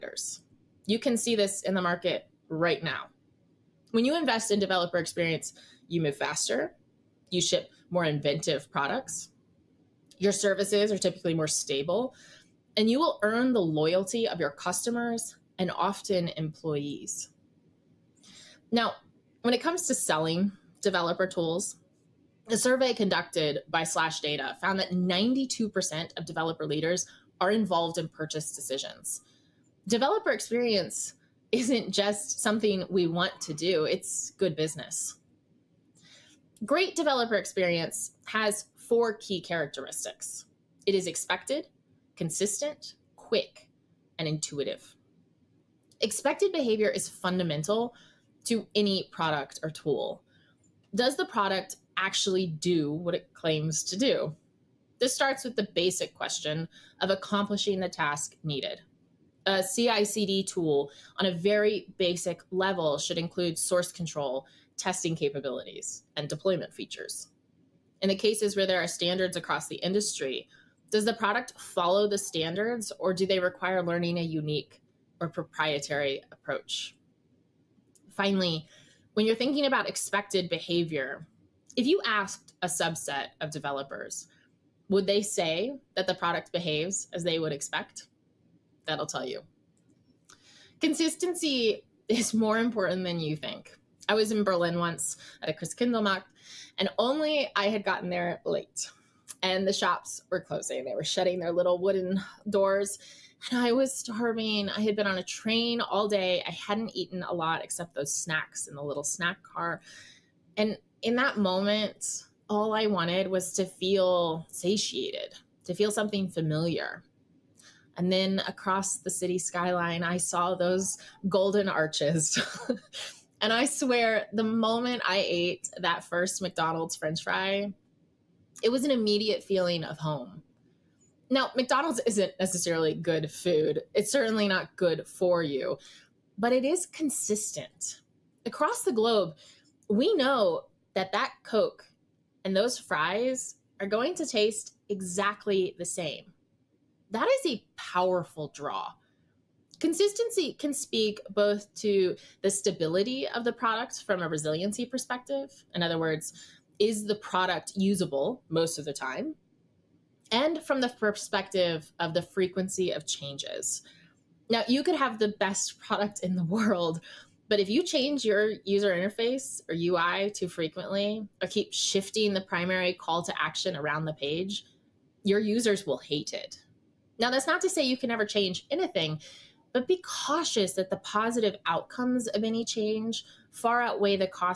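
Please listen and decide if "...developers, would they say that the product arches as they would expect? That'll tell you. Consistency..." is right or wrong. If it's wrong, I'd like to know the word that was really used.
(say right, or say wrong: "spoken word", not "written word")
wrong: "behaves", not "arches".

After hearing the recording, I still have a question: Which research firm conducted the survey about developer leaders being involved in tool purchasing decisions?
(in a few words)
SlashData.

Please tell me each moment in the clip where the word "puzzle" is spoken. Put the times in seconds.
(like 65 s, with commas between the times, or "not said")
not said.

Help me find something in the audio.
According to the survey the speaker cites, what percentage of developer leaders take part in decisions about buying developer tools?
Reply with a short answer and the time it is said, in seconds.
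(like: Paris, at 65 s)
92%, at 24 s.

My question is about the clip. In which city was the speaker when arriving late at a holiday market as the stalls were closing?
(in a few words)
Berlin.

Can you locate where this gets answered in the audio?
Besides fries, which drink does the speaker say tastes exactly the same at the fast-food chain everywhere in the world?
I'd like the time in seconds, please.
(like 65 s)
141 s.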